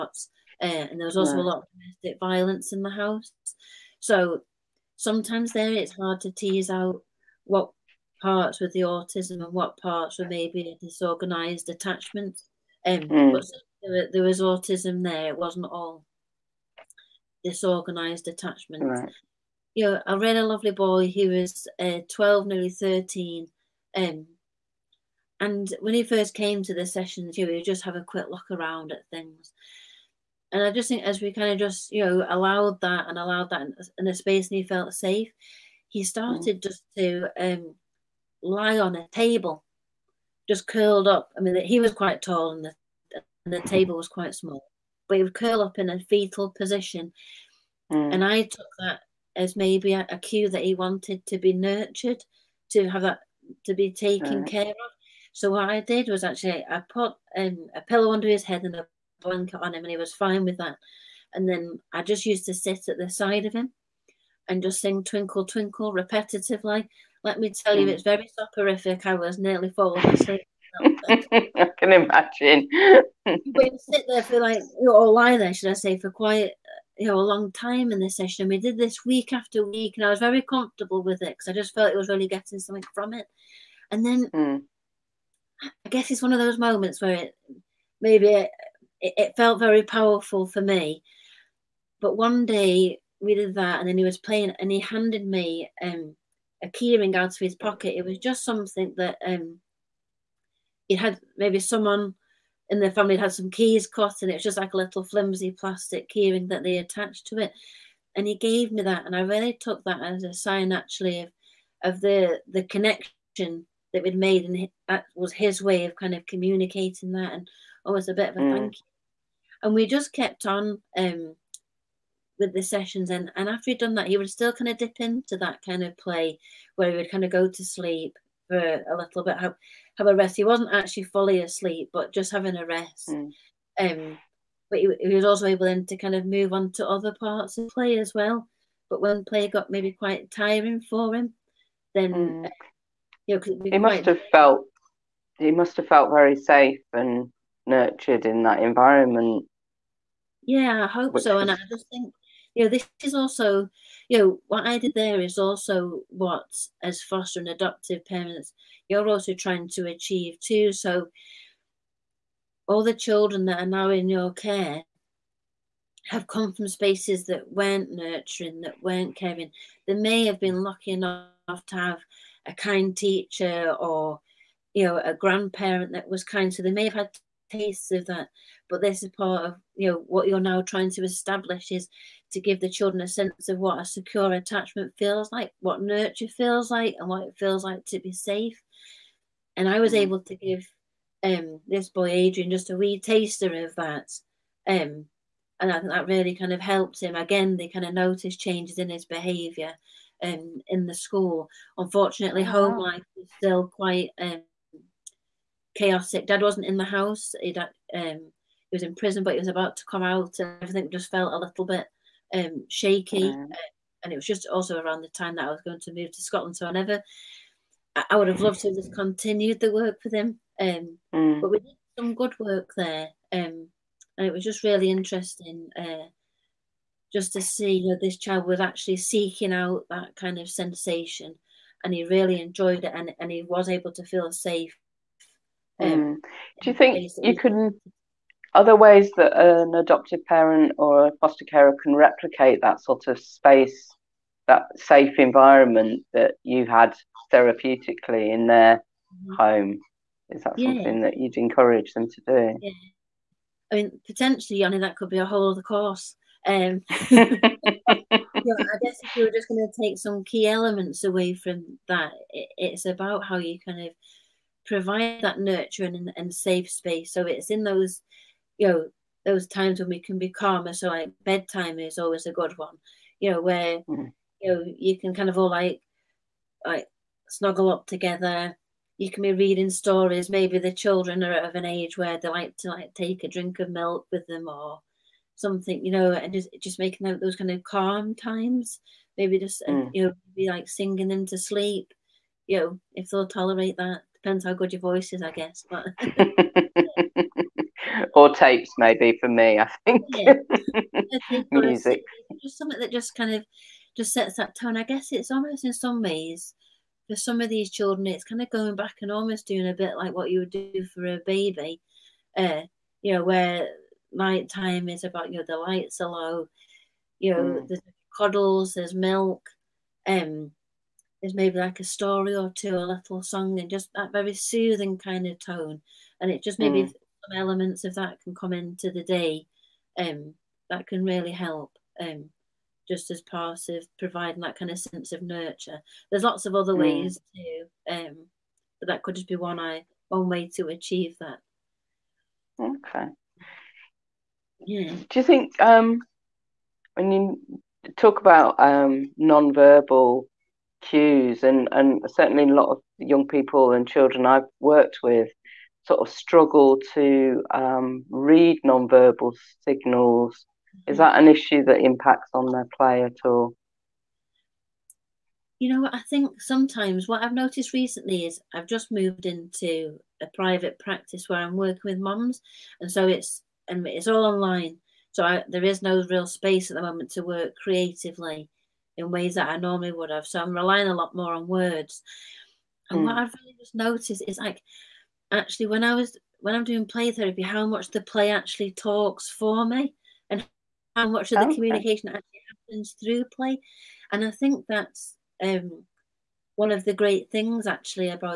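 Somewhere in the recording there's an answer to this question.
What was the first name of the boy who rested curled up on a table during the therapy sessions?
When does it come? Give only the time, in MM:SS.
03:12.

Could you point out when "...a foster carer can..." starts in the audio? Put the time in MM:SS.
04:01.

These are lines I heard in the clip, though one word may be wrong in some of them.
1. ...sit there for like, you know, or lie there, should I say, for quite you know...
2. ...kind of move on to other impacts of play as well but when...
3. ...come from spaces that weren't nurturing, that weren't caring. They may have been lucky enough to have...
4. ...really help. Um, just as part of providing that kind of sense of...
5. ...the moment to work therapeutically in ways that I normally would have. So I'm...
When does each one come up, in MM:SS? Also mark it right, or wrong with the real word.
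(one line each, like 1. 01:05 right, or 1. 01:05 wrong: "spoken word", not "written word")
1. 01:13 right
2. 02:15 wrong: "parts", not "impacts"
3. 02:46 right
4. 05:31 right
5. 06:16 wrong: "creatively", not "therapeutically".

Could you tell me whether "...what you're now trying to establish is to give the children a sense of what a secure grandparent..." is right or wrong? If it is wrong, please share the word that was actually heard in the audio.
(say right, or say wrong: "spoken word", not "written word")
wrong: "attachment", not "grandparent".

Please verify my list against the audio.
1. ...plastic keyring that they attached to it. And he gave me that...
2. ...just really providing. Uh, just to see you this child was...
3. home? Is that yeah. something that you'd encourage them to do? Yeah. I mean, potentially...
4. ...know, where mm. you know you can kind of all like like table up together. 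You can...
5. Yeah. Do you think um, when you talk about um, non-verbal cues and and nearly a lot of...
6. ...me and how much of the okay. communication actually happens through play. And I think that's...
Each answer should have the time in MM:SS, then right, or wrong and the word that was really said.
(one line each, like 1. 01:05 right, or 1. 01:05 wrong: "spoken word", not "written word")
1. 01:45 right
2. 03:44 wrong: "interesting", not "providing"
3. 04:09 right
4. 04:33 wrong: "snuggle", not "table"
5. 05:44 wrong: "certainly", not "nearly"
6. 06:29 right.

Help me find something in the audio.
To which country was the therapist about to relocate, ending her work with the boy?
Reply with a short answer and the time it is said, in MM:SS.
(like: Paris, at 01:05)
Scotland, at 03:36.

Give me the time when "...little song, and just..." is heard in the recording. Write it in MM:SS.
05:22.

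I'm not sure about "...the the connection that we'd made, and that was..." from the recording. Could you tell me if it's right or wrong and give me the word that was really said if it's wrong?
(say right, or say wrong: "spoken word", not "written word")
right.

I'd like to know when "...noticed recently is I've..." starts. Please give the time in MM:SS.
06:07.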